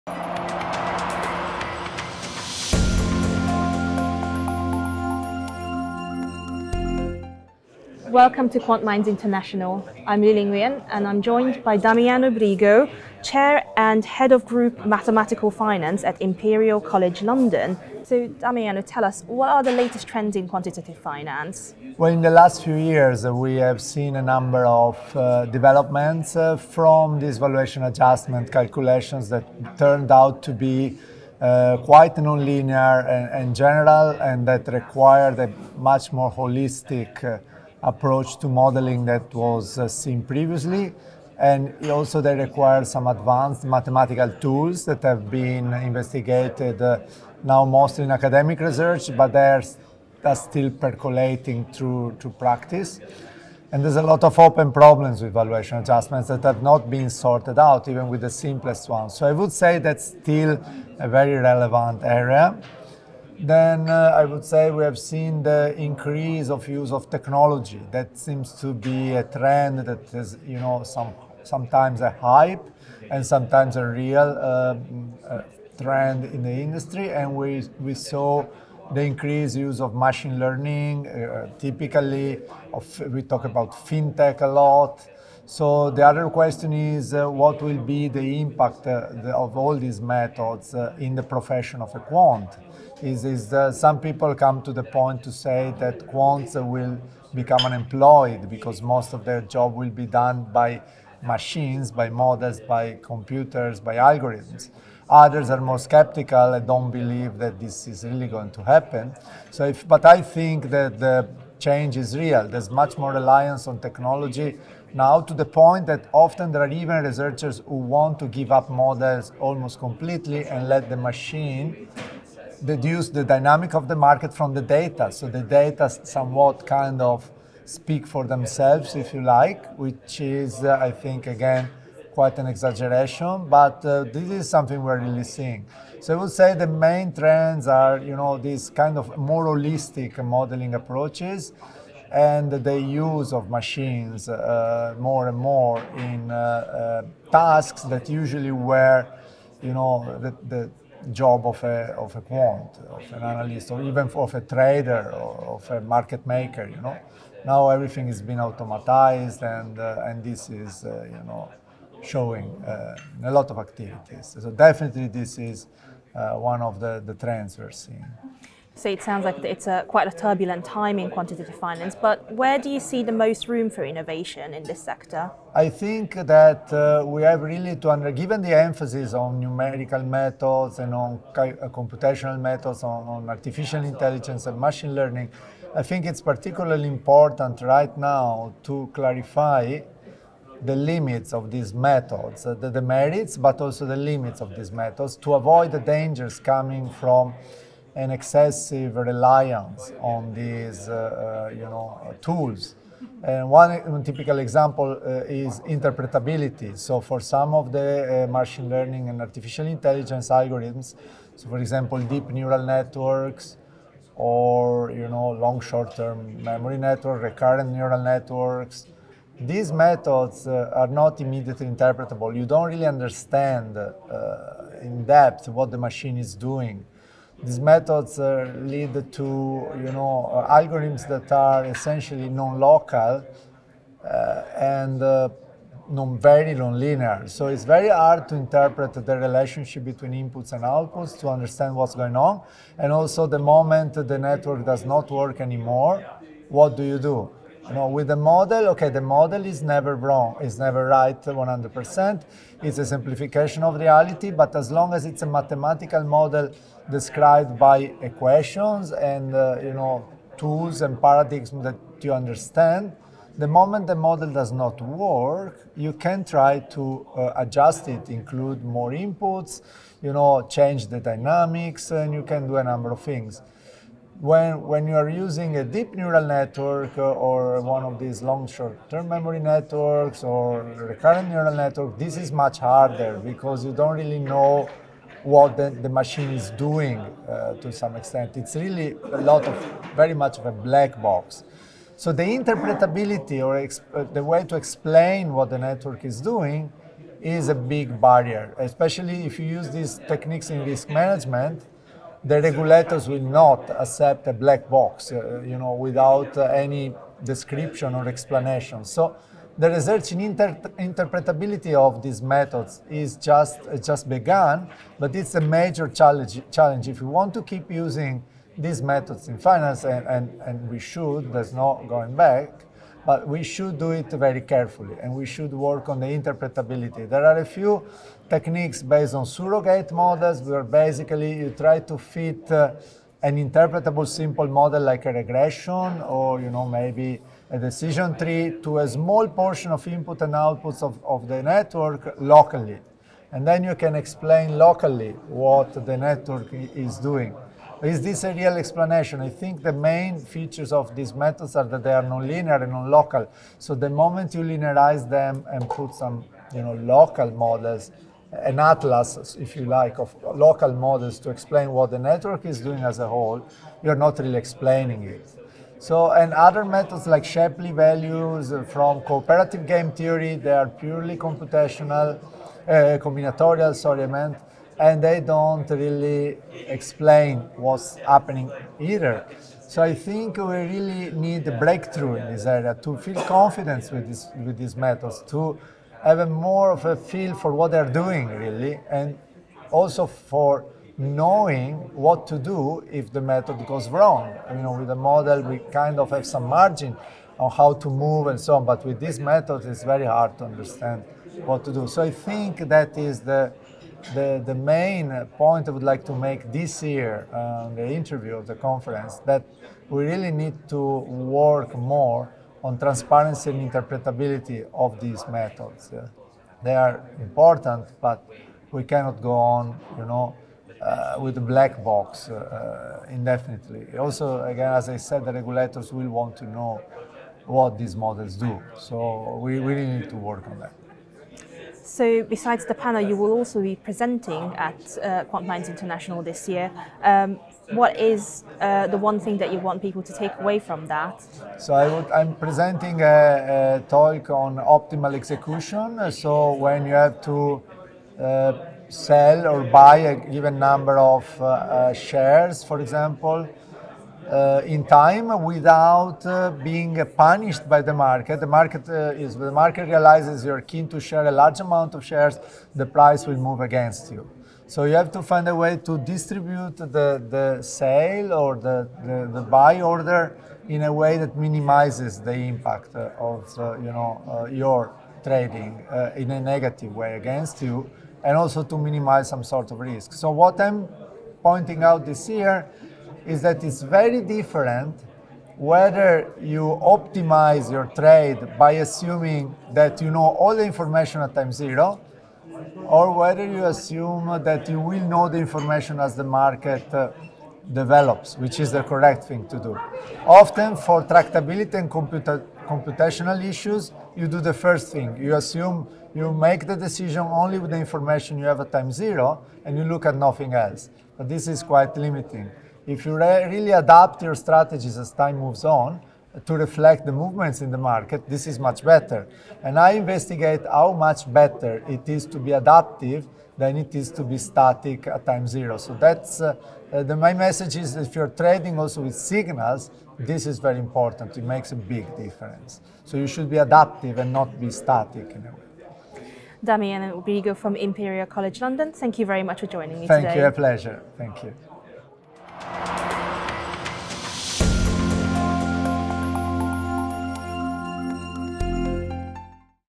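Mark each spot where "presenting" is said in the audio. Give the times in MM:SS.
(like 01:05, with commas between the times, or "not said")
07:13, 07:22.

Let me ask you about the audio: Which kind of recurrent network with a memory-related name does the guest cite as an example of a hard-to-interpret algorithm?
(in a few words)
long short-term memory network.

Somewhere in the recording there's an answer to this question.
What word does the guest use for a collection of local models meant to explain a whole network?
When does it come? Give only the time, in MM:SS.
05:58.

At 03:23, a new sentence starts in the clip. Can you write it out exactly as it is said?
And one typical example uh, is interpretability.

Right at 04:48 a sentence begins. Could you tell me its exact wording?
It's really a lot of, very much of a black box.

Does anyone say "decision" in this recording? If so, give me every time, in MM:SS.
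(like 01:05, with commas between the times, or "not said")
05:37, 08:26.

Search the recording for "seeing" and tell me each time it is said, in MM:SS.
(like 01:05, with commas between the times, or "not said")
02:15, 02:47.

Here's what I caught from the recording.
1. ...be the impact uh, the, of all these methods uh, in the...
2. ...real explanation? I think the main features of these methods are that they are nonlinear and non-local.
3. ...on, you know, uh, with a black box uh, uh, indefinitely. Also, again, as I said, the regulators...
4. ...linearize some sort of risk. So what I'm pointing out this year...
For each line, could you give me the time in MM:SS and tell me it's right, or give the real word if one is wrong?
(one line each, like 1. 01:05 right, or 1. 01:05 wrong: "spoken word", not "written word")
1. 01:27 right
2. 05:48 right
3. 06:59 right
4. 07:58 wrong: "minimize", not "linearize".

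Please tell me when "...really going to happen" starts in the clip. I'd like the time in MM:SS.
01:48.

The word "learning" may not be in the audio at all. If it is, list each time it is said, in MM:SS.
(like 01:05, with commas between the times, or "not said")
01:20, 03:04, 03:28.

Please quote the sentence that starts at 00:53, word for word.
And there's a lot of open problems with valuation adjustments that have not been sorted out, even with the simplest ones.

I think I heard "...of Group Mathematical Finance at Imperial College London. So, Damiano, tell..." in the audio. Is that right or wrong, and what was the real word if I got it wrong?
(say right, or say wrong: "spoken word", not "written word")
right.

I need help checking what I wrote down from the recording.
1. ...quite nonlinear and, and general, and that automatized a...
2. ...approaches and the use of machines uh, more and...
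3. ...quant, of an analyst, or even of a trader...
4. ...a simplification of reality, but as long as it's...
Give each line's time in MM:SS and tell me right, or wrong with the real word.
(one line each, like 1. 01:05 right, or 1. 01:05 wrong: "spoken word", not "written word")
1. 00:31 wrong: "required", not "automatized"
2. 02:20 right
3. 02:32 right
4. 04:12 right.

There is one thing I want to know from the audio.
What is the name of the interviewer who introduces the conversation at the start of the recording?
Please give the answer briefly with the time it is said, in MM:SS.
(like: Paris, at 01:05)
Liling Yuan, at 00:10.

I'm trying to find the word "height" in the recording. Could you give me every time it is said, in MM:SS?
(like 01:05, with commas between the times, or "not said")
not said.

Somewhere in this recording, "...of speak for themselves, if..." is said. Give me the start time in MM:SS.
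02:07.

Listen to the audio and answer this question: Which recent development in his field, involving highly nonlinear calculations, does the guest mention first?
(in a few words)
valuation adjustment.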